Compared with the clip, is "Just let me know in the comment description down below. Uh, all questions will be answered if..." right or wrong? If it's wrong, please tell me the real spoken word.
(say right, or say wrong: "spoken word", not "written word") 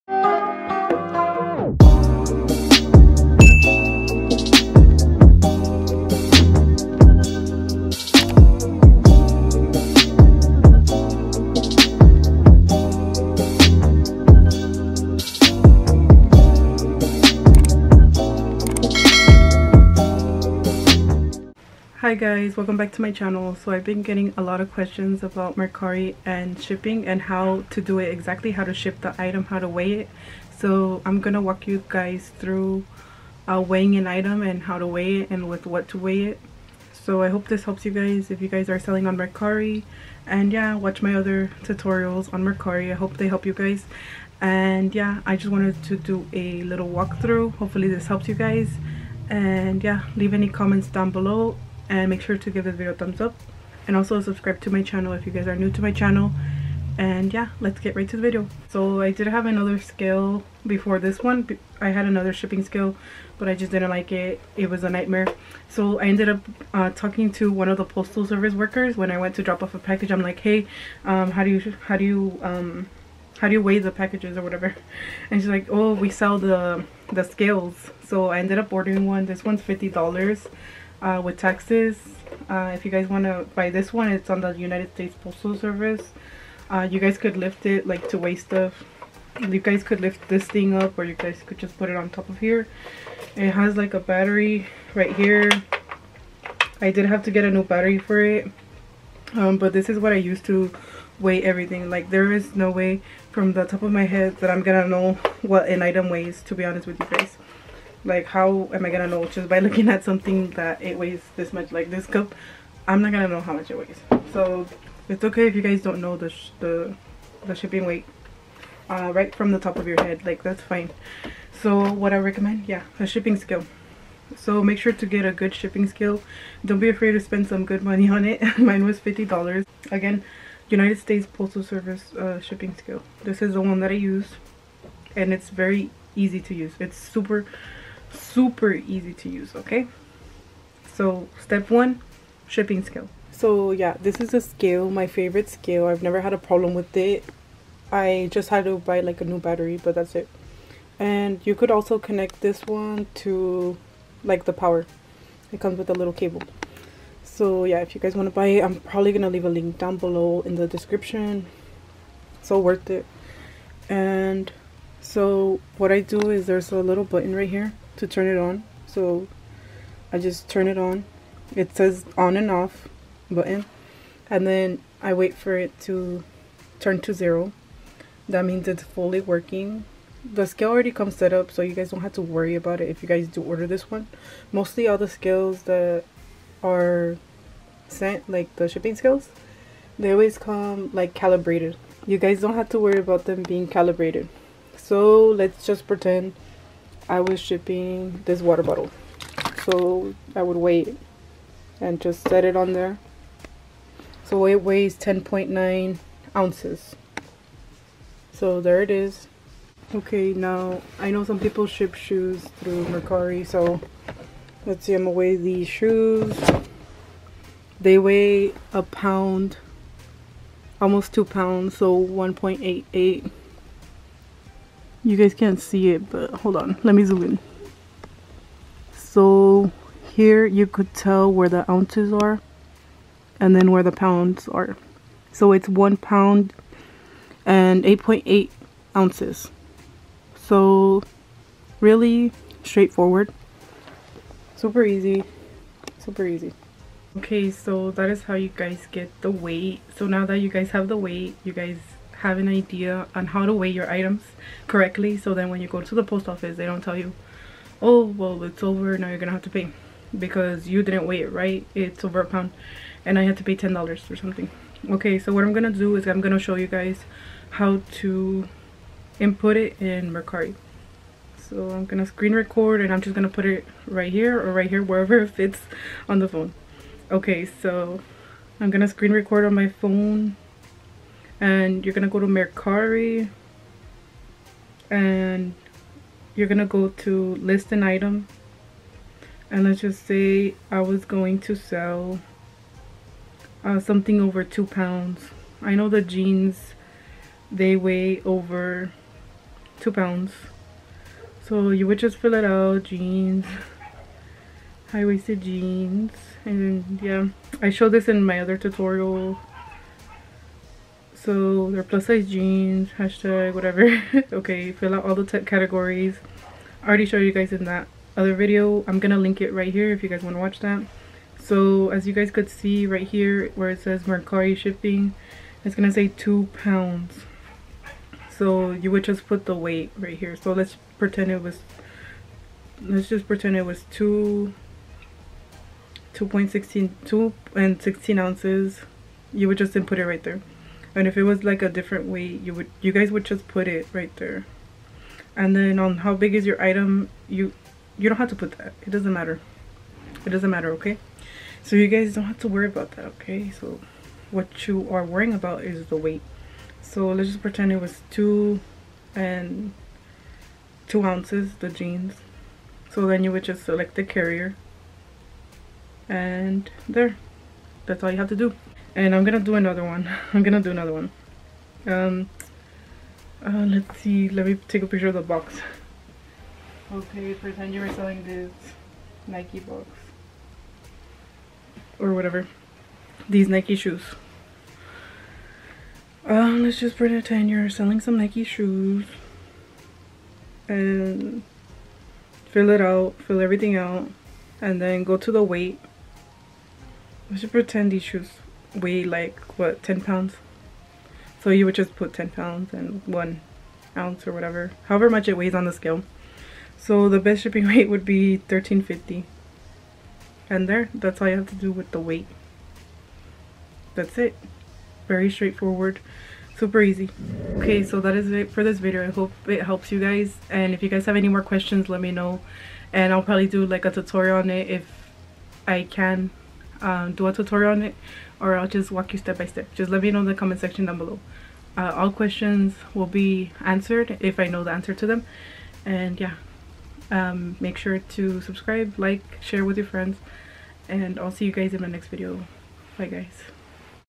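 wrong: "section", not "description".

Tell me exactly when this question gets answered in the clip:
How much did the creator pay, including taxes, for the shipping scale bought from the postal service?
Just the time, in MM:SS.
01:19.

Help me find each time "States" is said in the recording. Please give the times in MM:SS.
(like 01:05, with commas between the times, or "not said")
01:24, 02:10.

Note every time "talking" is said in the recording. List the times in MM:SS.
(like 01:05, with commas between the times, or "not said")
01:06.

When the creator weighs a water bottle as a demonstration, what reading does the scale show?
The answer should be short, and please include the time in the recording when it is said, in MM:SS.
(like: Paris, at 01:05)
10.9 ounces, at 03:24.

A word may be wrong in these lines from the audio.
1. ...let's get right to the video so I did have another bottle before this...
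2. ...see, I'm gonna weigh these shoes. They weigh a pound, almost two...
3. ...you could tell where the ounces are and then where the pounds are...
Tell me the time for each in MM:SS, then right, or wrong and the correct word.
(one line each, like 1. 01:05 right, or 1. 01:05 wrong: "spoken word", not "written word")
1. 00:57 wrong: "scale", not "bottle"
2. 03:34 right
3. 03:50 right.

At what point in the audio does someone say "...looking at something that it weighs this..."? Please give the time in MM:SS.
01:49.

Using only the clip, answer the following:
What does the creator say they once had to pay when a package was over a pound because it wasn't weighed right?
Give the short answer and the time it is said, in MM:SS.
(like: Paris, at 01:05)
$10, at 04:23.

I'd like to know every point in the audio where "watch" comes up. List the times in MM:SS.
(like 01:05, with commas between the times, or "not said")
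00:40, 05:20.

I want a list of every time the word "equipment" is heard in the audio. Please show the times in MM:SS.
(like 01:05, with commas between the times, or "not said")
not said.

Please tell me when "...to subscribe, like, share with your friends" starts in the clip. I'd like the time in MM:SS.
07:17.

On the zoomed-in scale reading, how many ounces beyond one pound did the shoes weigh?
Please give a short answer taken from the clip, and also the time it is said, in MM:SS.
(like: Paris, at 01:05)
8.8 ounces, at 03:57.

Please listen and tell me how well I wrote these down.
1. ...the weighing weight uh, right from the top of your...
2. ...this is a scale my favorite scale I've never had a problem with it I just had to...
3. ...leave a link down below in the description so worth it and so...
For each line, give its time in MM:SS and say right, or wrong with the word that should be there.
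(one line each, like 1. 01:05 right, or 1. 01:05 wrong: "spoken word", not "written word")
1. 01:57 wrong: "shipping", not "weighing"
2. 02:24 right
3. 02:39 right.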